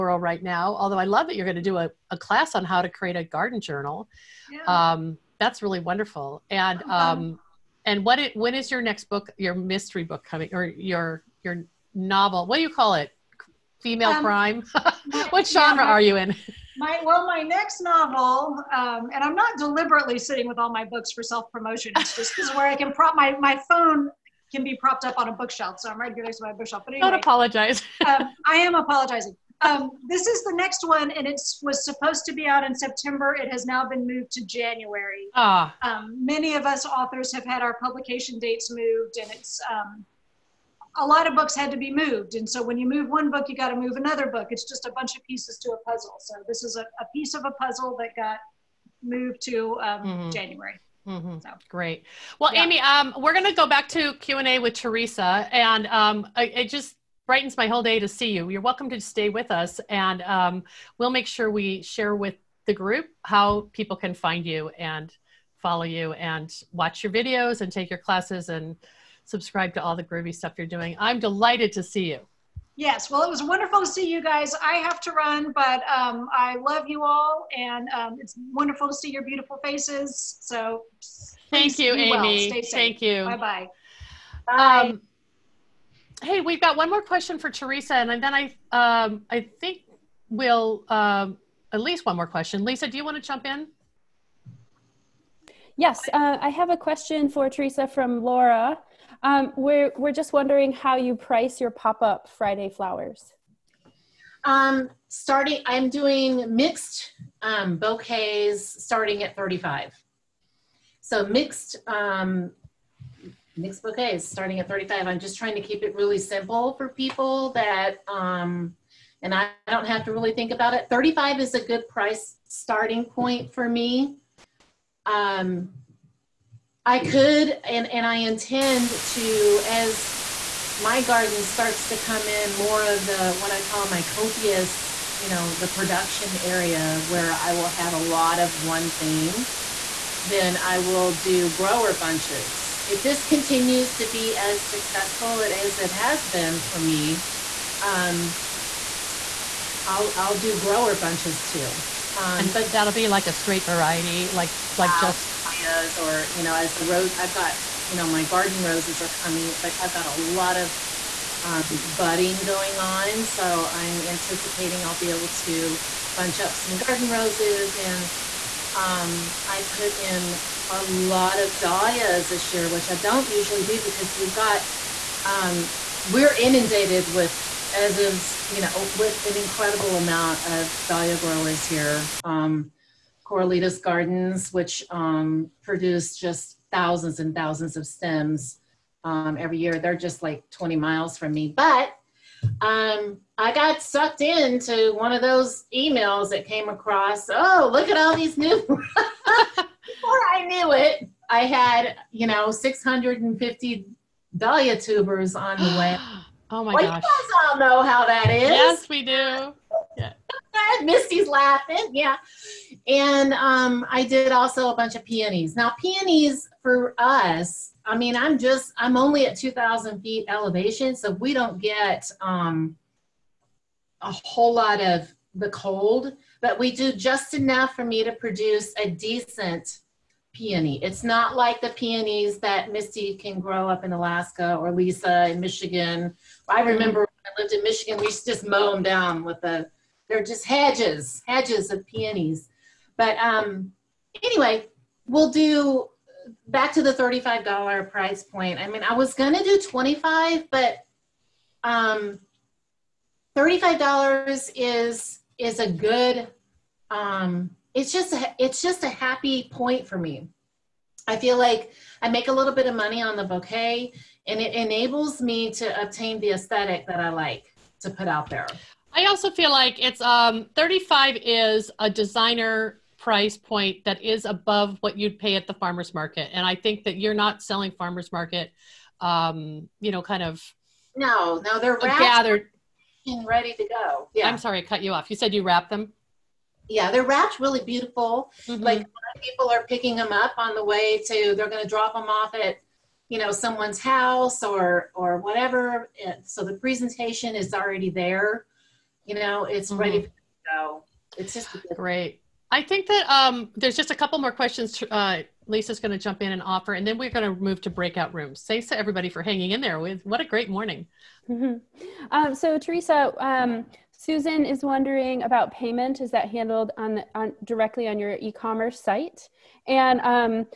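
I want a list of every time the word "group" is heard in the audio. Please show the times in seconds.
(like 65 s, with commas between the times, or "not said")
62 s.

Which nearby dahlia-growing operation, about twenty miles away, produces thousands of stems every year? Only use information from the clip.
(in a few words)
Corralitos Gardens.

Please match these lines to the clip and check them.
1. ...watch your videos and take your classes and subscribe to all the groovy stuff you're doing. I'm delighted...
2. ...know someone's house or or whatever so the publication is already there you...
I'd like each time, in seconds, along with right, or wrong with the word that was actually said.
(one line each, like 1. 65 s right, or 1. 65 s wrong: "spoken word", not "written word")
1. 66 s right
2. 293 s wrong: "presentation", not "publication".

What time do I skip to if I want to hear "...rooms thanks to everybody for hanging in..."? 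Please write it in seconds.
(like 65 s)
308 s.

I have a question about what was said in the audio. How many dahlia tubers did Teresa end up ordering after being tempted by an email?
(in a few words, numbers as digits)
650.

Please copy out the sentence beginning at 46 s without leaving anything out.
So this is a, a piece of a puzzle that got moved to um, mm-hmm.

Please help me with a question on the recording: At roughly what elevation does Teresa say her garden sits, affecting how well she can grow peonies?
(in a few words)
2,000 feet.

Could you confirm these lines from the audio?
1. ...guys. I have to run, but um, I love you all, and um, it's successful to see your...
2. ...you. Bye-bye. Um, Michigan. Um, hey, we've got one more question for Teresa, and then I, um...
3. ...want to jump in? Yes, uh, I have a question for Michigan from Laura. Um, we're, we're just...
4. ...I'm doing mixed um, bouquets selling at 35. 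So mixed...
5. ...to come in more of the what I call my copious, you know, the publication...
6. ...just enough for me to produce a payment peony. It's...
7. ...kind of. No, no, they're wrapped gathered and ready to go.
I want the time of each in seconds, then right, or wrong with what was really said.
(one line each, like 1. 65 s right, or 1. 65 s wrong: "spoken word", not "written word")
1. 74 s wrong: "wonderful", not "successful"
2. 83 s wrong: "Bye", not "Michigan"
3. 93 s wrong: "Teresa", not "Michigan"
4. 105 s wrong: "starting", not "selling"
5. 131 s wrong: "production", not "publication"
6. 226 s wrong: "decent", not "payment"
7. 280 s right.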